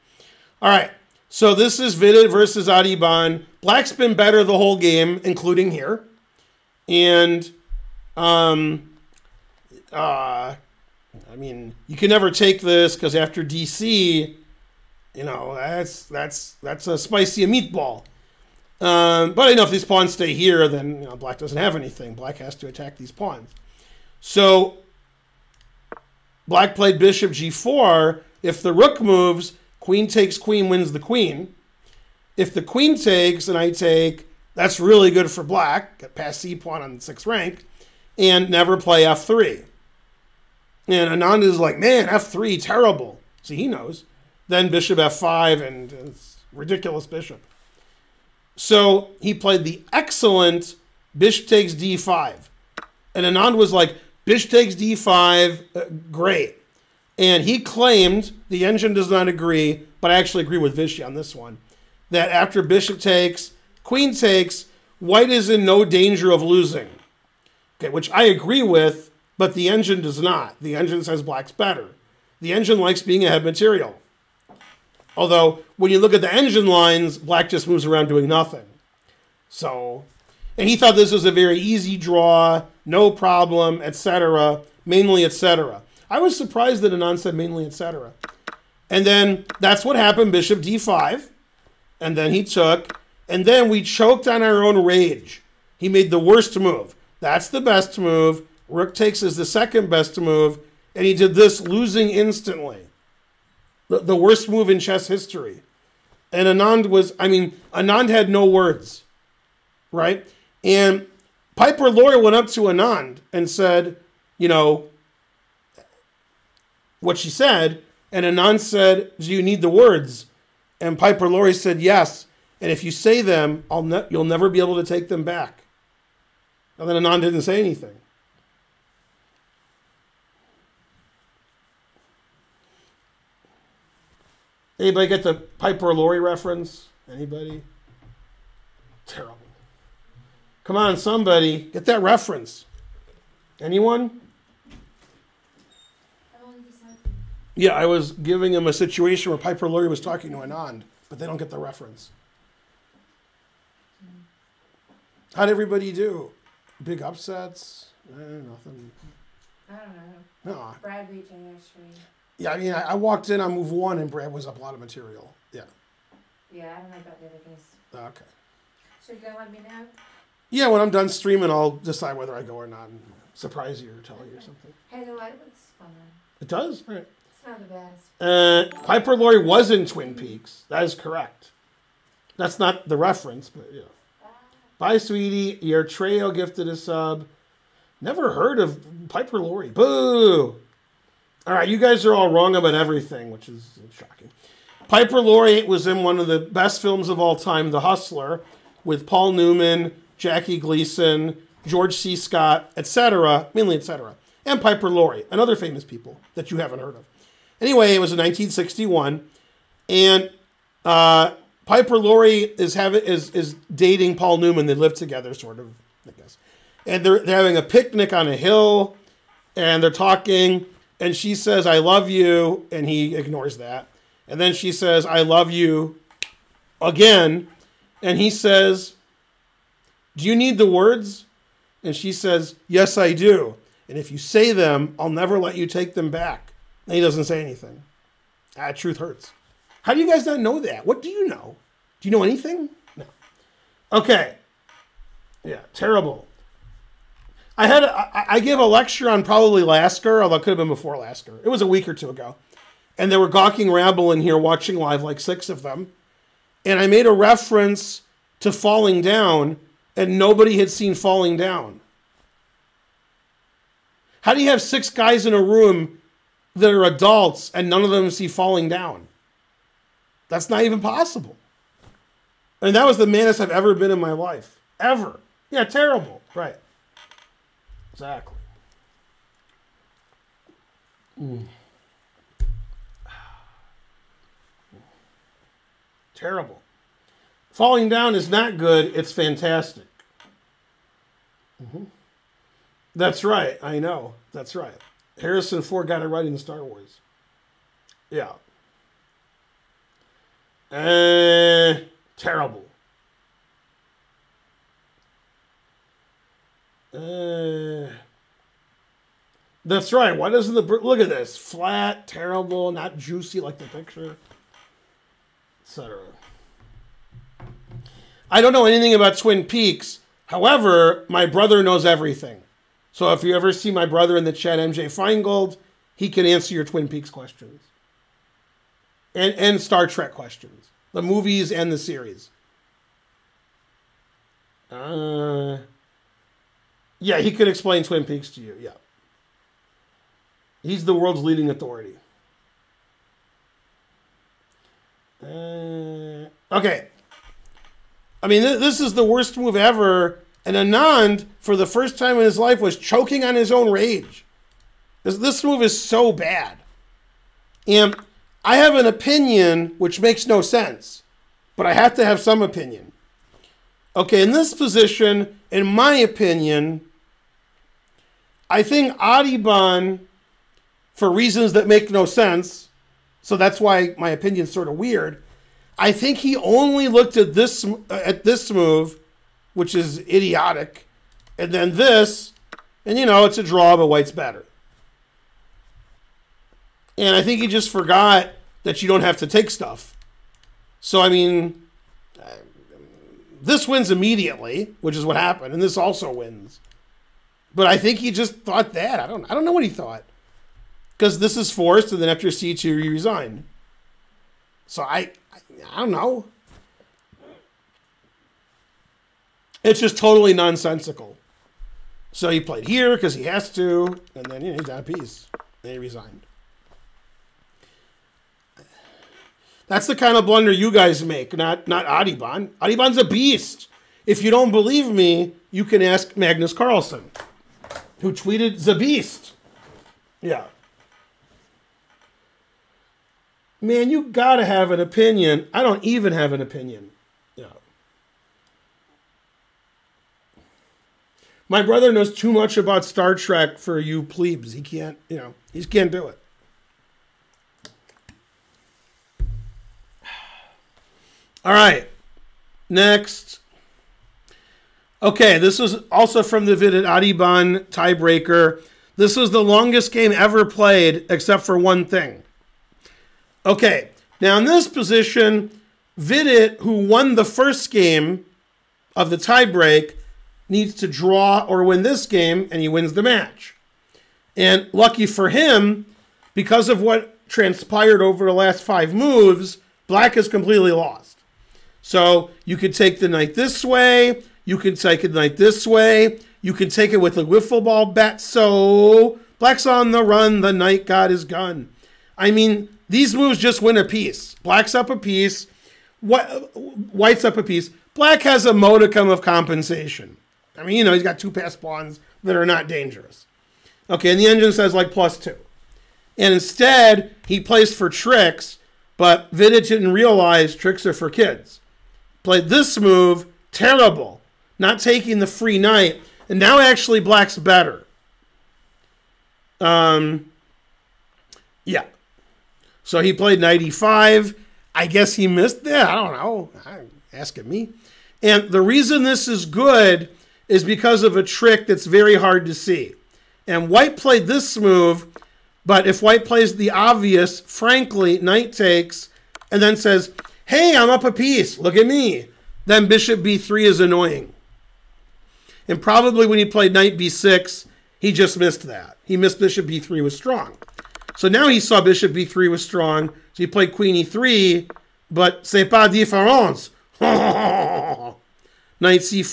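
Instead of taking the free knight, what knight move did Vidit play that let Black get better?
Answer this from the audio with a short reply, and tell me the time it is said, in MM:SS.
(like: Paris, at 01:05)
Knight e5, at 08:43.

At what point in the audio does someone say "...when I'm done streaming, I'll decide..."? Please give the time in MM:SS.
02:50.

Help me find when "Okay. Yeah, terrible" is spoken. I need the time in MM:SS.
04:03.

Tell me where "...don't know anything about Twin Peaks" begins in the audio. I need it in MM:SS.
05:18.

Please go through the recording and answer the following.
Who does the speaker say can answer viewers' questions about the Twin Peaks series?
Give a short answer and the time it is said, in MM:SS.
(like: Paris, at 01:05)
MJ Finegold, at 05:24.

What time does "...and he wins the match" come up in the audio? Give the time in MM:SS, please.
07:52.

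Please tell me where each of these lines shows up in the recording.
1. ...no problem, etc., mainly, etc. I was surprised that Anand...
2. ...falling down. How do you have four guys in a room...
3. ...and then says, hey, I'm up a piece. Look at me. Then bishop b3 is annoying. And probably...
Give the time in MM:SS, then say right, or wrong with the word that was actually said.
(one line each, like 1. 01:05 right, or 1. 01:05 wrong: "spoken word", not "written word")
1. 01:22 right
2. 04:20 wrong: "six", not "four"
3. 08:59 right.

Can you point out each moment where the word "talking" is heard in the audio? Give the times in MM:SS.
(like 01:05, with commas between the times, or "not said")
02:29, 03:39.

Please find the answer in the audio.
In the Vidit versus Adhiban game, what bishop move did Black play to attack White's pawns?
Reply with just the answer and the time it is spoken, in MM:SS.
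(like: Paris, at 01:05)
Bishop g4, at 00:26.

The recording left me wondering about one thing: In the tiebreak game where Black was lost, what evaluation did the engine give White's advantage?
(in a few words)
Plus two.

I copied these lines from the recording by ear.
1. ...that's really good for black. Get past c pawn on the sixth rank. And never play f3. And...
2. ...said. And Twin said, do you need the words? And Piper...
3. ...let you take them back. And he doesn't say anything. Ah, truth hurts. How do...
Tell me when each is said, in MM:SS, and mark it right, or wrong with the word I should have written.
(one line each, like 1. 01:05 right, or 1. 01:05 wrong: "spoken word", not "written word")
1. 00:34 right
2. 01:57 wrong: "Anand", not "Twin"
3. 03:55 right.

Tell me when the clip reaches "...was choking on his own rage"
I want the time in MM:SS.
05:52.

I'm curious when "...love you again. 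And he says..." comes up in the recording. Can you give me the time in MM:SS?
03:45.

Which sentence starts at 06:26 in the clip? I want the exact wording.
And I think he just forgot that you don't have to take stuff.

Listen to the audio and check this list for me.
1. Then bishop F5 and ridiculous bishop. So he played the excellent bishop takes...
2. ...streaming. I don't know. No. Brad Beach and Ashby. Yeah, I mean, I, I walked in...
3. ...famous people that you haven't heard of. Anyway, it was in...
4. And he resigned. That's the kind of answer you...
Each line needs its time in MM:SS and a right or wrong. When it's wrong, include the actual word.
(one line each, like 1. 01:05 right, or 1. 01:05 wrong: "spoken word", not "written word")
1. 00:44 right
2. 02:38 wrong: "nothing", not "streaming"
3. 03:25 right
4. 06:55 wrong: "blunder", not "answer".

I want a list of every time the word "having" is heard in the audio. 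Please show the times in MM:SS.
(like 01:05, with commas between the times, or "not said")
03:32, 03:37.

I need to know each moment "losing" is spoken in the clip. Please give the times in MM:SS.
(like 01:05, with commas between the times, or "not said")
01:06, 01:41.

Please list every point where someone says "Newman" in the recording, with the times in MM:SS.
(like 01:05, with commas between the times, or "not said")
03:19, 03:34.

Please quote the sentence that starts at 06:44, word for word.
So I, I, I don't know.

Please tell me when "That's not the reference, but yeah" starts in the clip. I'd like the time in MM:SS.
03:02.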